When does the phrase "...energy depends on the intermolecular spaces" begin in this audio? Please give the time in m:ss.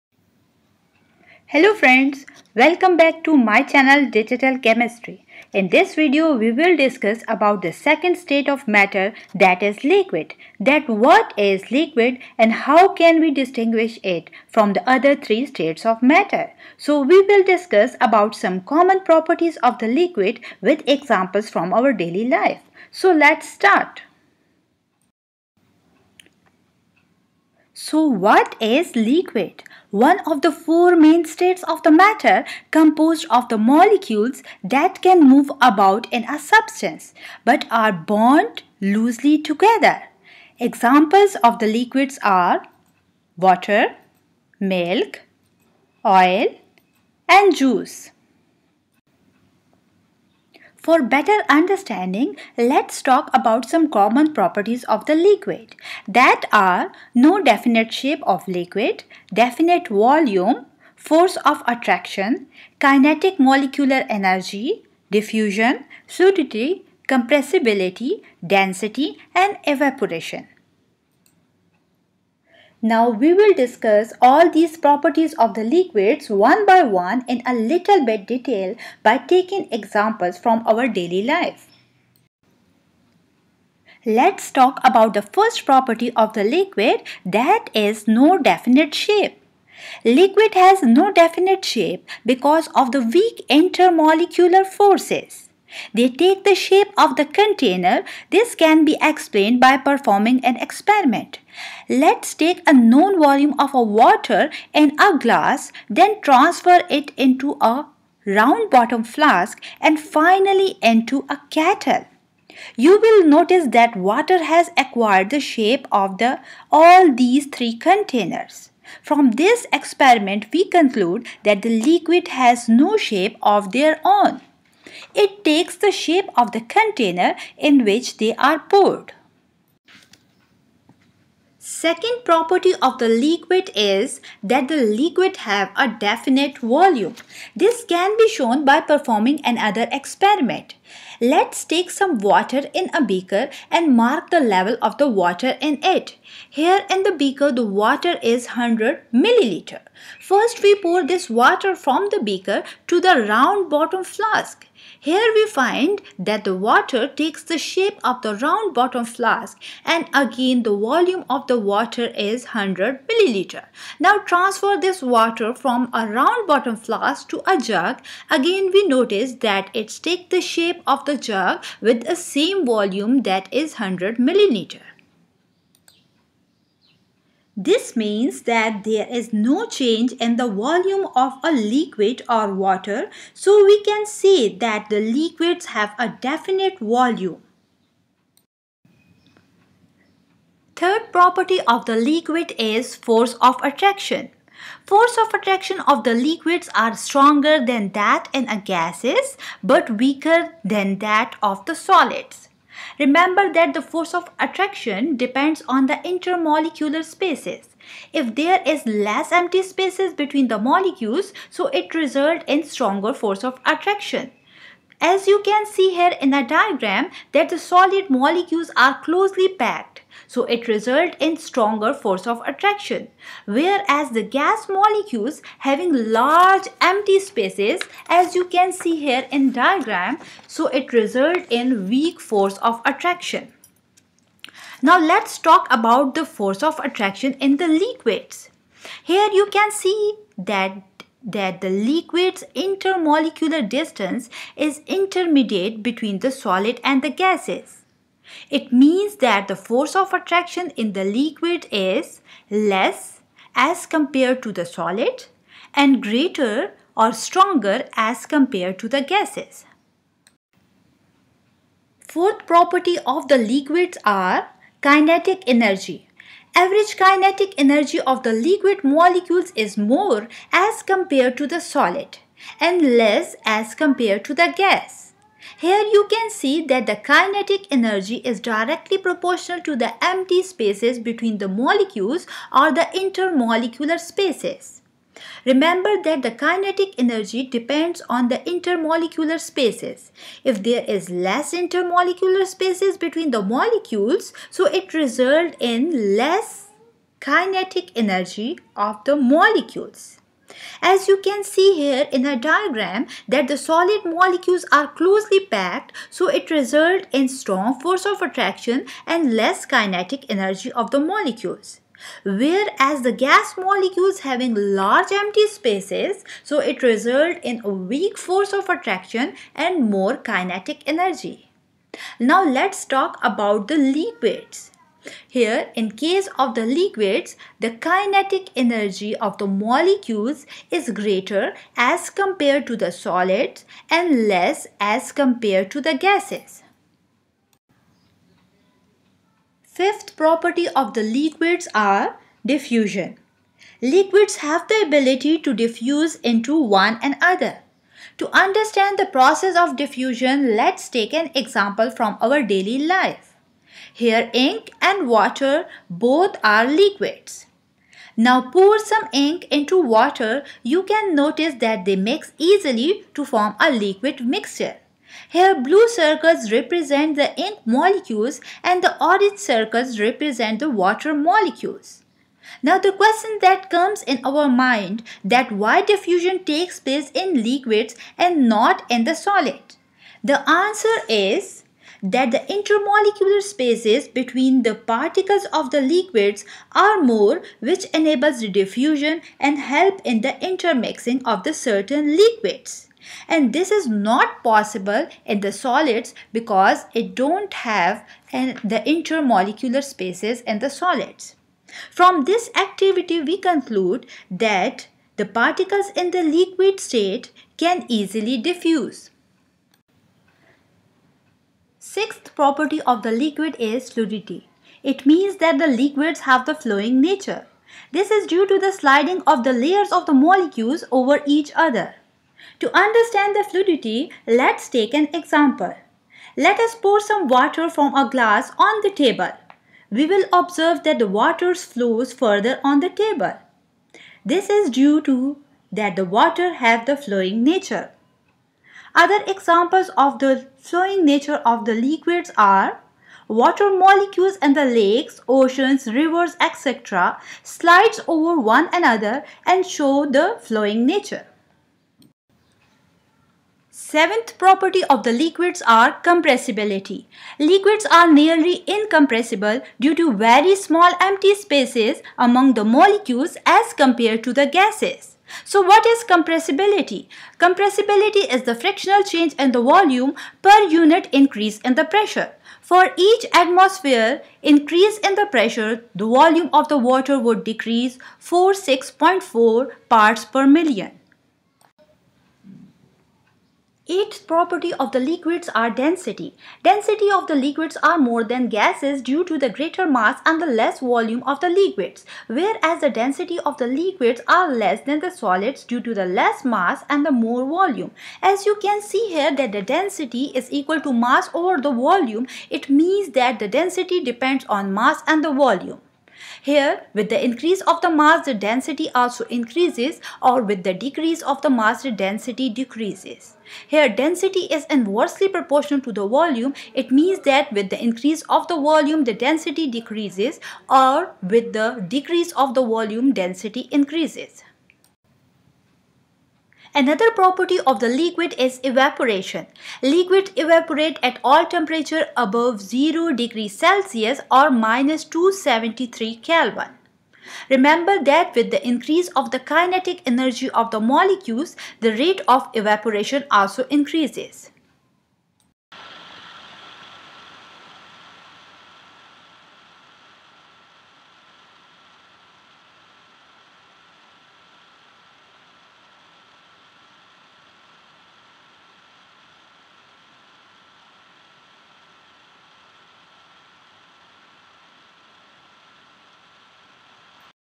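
4:46.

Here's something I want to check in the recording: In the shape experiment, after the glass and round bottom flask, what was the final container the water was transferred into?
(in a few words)
kettle.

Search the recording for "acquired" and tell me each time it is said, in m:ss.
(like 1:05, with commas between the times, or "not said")
1:54.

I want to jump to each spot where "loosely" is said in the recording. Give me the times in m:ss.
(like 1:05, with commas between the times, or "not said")
0:38.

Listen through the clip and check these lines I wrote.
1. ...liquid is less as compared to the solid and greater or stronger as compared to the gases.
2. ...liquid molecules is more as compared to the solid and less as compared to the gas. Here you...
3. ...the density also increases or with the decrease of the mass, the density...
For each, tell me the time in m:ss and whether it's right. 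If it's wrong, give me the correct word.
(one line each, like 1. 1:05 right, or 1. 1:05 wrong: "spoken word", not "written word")
1. 4:11 right
2. 4:28 right
3. 8:28 right.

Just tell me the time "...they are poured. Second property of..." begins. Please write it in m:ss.
2:08.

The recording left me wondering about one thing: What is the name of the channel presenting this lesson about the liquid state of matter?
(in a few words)
Digital Kemistry.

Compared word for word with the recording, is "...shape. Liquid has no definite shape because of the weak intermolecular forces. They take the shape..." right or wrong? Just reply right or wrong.
right.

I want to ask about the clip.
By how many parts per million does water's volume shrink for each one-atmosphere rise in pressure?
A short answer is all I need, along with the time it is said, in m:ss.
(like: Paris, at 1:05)
46.4, at 7:58.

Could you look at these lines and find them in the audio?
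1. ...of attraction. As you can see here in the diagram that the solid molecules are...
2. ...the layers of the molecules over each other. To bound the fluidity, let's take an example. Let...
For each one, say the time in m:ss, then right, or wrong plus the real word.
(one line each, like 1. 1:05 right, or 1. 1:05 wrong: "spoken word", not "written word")
1. 3:33 right
2. 6:59 wrong: "understand", not "bound".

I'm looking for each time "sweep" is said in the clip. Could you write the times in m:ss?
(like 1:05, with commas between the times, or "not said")
not said.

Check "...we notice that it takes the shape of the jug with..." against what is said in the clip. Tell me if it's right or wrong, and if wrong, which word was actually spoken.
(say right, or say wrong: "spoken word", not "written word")
right.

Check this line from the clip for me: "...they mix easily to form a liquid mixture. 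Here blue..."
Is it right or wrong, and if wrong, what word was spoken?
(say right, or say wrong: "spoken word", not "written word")
right.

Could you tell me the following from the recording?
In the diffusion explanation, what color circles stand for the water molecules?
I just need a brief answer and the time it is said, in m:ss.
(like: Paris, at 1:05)
orange, at 6:09.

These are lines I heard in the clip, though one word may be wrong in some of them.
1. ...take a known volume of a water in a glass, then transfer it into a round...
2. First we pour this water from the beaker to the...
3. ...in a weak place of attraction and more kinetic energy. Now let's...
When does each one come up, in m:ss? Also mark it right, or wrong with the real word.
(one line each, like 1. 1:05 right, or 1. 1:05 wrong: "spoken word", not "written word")
1. 1:42 right
2. 2:30 right
3. 5:17 wrong: "force", not "place".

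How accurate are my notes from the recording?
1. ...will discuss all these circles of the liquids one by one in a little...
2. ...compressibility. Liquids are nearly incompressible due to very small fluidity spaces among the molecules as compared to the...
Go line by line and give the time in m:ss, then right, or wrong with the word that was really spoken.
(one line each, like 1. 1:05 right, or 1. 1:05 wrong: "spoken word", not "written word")
1. 1:13 wrong: "properties", not "circles"
2. 7:36 wrong: "empty", not "fluidity".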